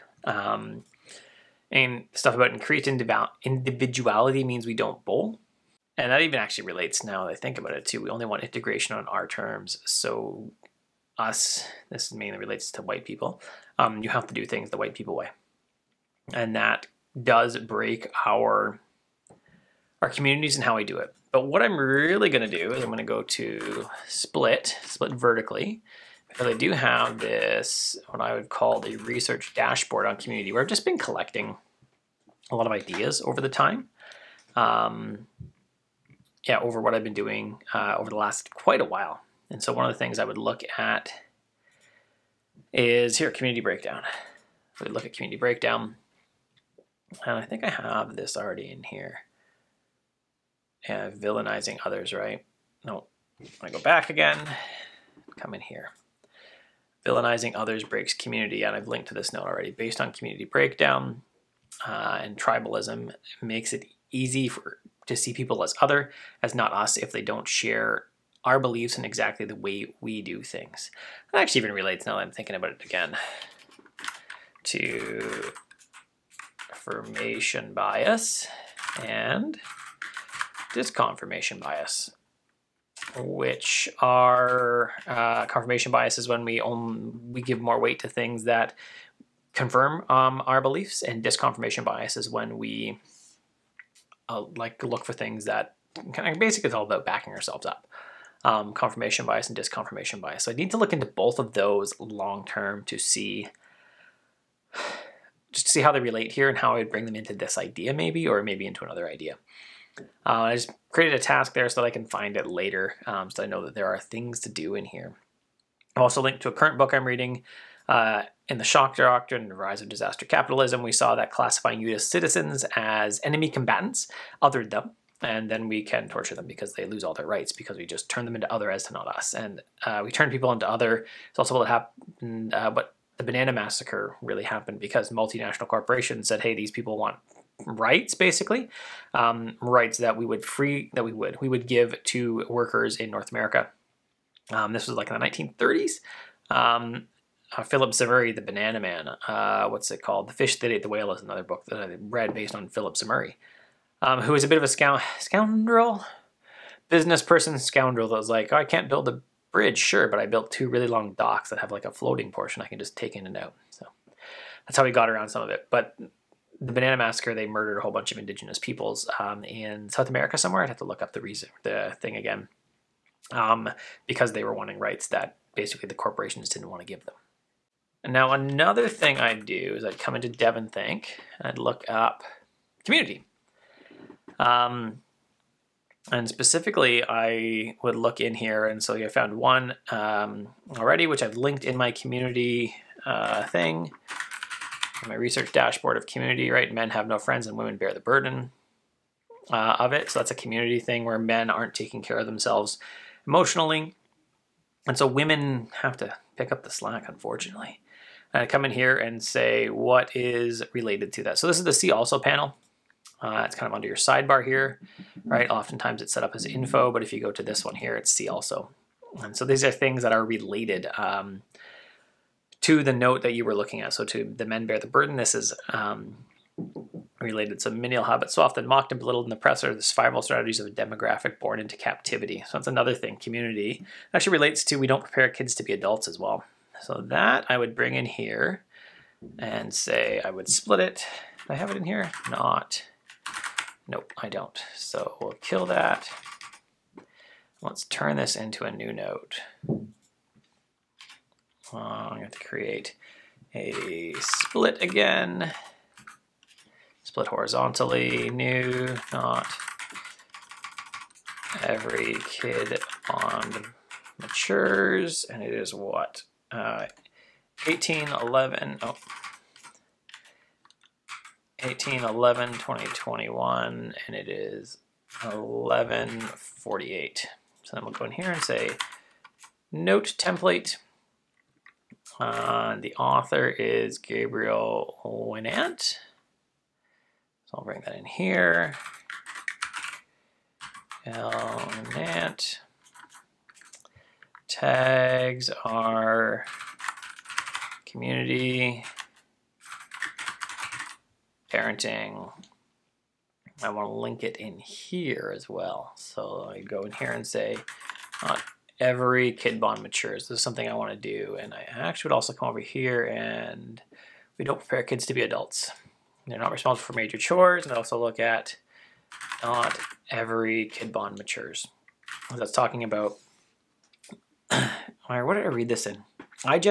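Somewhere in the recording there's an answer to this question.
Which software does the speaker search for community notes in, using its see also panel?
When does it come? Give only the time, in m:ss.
3:00.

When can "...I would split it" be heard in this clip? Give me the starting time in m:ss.
4:00.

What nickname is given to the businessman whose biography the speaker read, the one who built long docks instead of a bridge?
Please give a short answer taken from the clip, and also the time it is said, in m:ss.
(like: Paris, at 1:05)
The Banana Man, at 2:28.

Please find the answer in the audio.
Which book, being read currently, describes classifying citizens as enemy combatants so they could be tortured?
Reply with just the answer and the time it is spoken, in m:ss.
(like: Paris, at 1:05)
The Shock Doctrine, at 1:58.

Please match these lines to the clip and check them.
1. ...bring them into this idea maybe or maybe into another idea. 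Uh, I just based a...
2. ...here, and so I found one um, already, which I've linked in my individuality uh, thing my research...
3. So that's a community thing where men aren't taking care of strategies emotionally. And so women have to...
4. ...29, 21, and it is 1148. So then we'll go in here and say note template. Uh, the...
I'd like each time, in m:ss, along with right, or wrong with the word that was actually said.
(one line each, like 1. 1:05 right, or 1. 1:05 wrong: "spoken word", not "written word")
1. 1:46 wrong: "created", not "based"
2. 3:08 wrong: "community", not "individuality"
3. 3:20 wrong: "themselves", not "strategies"
4. 4:32 wrong: "20", not "29".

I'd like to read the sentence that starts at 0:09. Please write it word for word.
So, us, this mainly relates to white people, um, you have to do things the white people way.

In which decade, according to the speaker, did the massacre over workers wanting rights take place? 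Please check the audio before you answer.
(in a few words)
1930s.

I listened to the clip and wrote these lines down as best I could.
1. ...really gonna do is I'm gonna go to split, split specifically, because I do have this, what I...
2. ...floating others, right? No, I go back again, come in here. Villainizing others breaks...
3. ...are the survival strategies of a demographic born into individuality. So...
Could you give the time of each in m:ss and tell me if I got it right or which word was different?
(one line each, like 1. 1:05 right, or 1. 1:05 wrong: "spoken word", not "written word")
1. 0:21 wrong: "vertically", not "specifically"
2. 0:51 wrong: "villainizing", not "floating"
3. 3:49 wrong: "captivity", not "individuality".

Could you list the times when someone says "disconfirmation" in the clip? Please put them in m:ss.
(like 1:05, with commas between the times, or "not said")
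1:20, 1:31, 1:39.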